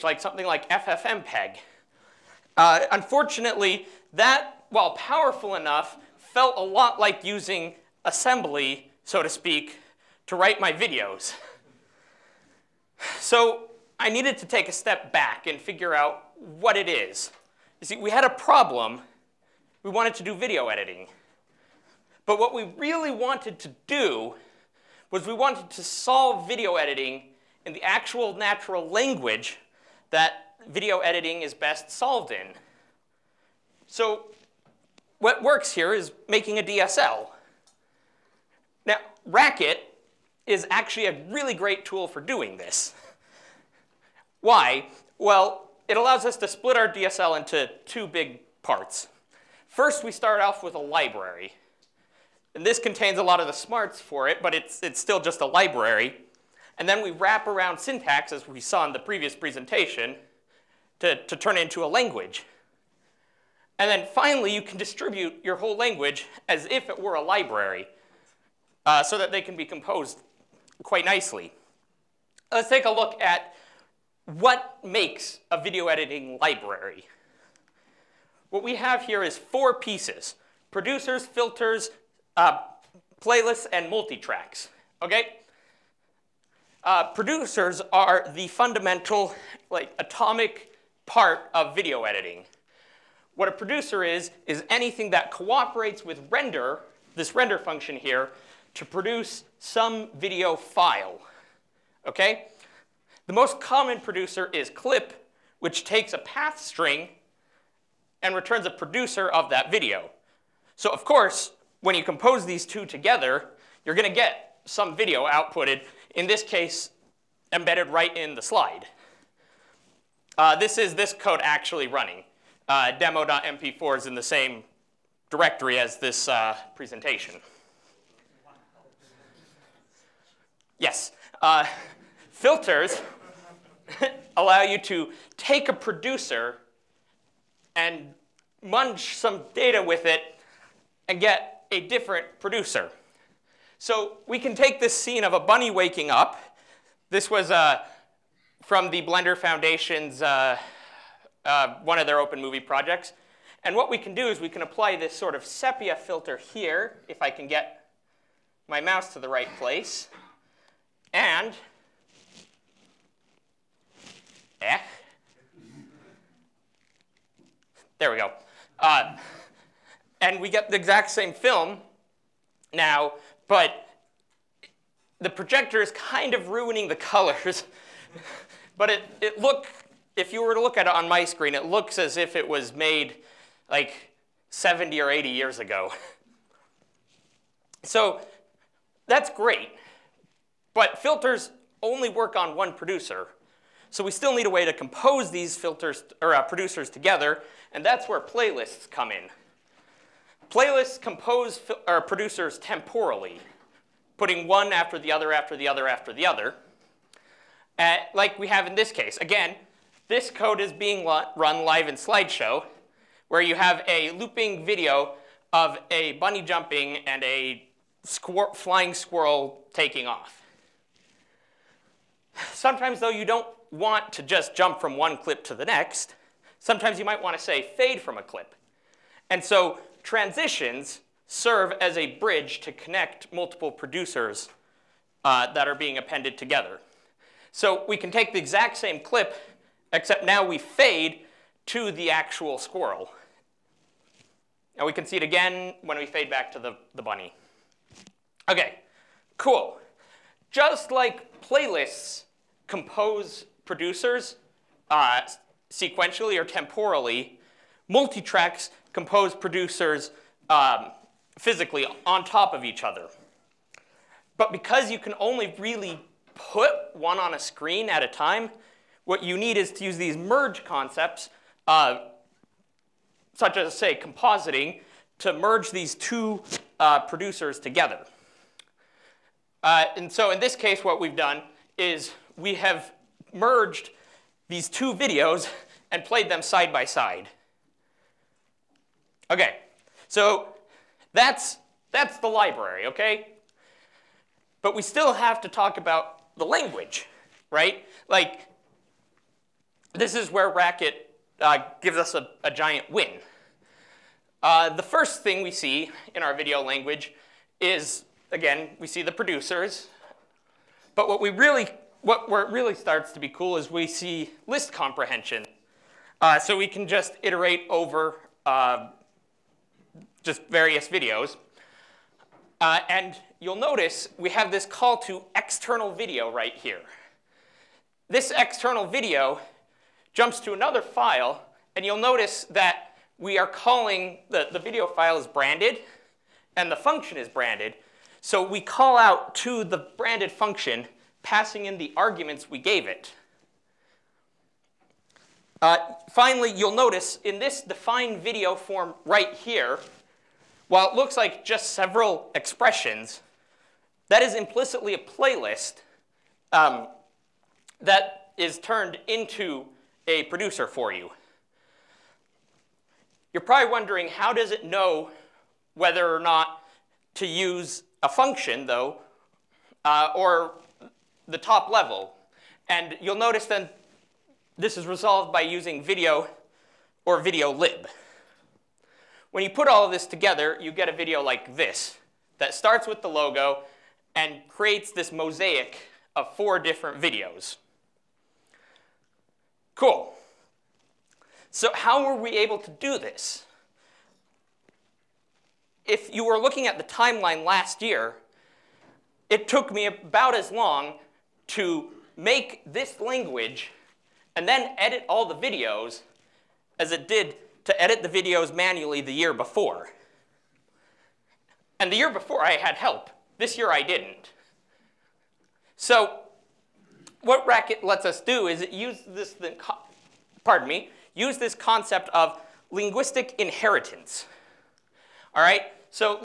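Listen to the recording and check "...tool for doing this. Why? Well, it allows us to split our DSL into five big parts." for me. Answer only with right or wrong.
wrong.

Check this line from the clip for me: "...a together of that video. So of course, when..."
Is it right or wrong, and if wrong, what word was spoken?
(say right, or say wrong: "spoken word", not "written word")
wrong: "producer", not "together".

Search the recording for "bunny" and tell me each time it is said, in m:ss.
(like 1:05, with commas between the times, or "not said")
2:25, 3:36, 4:07.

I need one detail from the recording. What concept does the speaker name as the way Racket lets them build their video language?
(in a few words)
linguistic inheritance.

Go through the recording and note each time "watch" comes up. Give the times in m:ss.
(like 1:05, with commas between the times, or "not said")
not said.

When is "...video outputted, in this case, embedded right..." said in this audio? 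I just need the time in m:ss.
1:54.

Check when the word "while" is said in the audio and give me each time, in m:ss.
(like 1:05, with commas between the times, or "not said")
0:04, 5:50.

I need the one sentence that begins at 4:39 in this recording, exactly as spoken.
Uh, and so in this case, what we've done is we have merged these two videos and played them side by side.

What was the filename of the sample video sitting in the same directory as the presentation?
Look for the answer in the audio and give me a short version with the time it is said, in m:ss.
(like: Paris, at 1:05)
demo.mp4, at 2:02.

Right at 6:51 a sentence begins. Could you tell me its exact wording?
And the year before I had help.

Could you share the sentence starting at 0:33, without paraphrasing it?
So what works here is making a DSL.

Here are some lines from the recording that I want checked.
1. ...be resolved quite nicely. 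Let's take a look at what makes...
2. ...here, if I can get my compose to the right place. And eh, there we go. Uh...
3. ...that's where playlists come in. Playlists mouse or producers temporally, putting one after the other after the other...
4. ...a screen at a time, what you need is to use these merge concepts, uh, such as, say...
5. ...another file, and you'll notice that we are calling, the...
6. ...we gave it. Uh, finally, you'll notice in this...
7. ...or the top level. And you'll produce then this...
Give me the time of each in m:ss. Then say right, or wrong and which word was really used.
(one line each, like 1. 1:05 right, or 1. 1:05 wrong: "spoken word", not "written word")
1. 1:09 wrong: "composed", not "resolved"
2. 2:36 wrong: "mouse", not "compose"
3. 3:17 wrong: "compose", not "mouse"
4. 4:27 right
5. 5:30 right
6. 5:42 right
7. 6:10 wrong: "notice", not "produce".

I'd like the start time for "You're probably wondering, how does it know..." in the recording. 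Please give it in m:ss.
6:03.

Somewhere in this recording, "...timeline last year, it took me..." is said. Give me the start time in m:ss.
6:36.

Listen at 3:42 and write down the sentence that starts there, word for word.
Sometimes, though, you don't want to just jump from one clip to the next.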